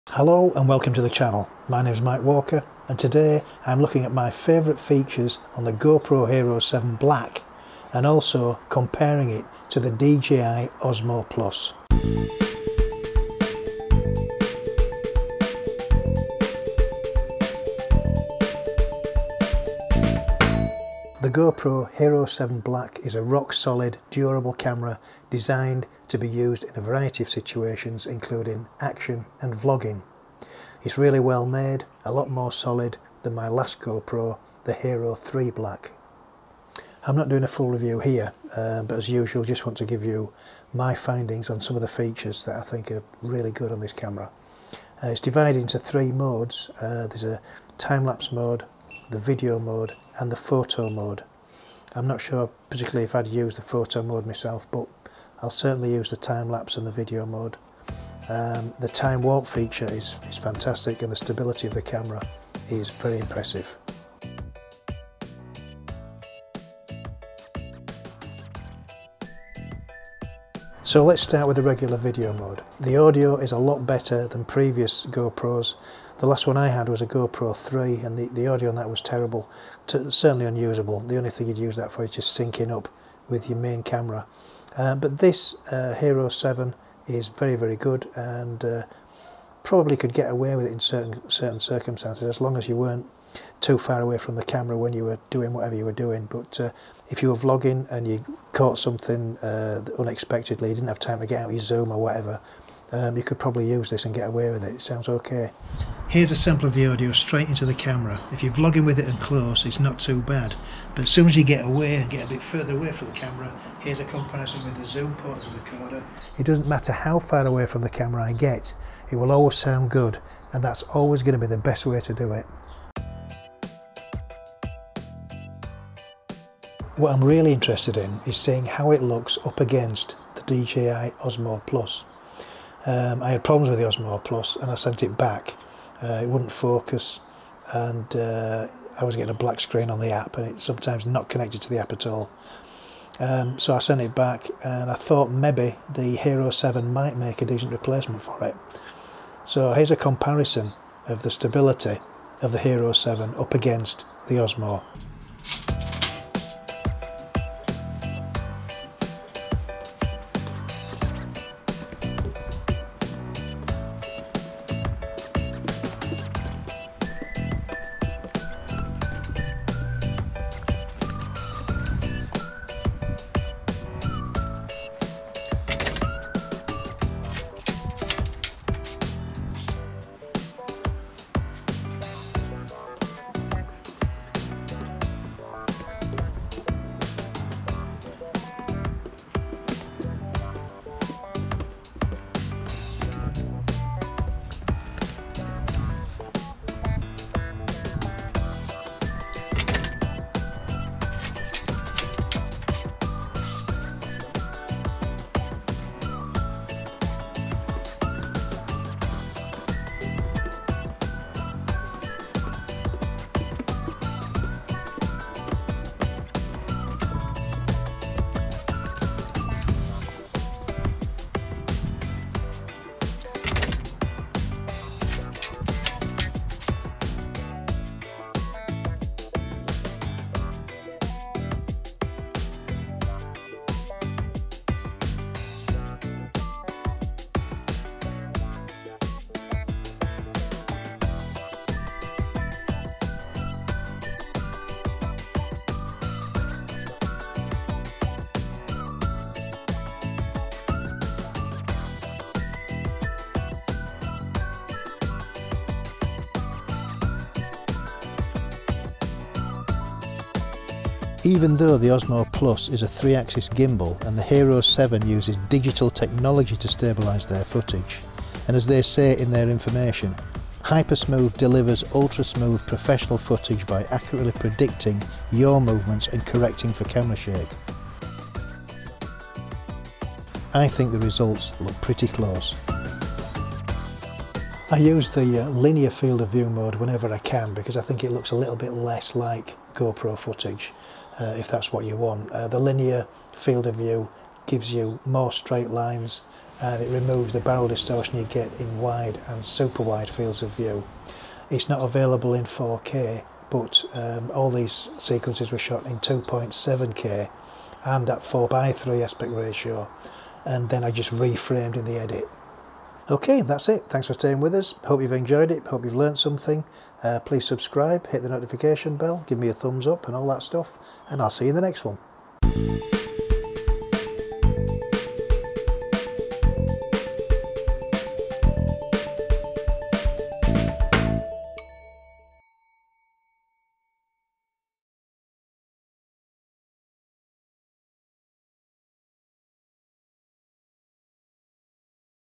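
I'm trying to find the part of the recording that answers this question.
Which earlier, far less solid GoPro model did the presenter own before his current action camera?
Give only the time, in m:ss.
0:34.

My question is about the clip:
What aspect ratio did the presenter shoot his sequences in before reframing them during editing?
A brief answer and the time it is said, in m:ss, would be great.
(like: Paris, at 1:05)
4 by 3, at 5:08.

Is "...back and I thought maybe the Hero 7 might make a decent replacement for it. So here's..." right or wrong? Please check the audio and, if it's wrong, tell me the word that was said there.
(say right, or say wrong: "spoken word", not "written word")
right.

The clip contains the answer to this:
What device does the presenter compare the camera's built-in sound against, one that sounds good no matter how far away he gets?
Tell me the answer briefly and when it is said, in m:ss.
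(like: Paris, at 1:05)
Zoom portable recorder, at 1:54.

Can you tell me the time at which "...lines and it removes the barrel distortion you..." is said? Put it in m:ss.
4:55.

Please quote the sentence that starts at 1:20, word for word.
The only thing you'd use that for is just syncing up with your main camera.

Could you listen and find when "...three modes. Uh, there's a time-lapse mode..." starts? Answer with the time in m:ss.
0:45.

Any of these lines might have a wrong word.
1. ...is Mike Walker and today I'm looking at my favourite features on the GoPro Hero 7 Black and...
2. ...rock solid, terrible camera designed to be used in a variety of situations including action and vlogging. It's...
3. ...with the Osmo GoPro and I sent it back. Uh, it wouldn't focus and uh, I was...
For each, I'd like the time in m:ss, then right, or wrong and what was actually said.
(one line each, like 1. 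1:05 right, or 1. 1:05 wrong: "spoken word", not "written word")
1. 0:01 right
2. 0:23 wrong: "durable", not "terrible"
3. 2:13 wrong: "Plus", not "GoPro".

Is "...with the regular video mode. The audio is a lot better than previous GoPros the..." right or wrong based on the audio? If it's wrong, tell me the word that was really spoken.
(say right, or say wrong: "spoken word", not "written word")
right.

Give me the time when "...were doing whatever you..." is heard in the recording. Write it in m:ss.
1:35.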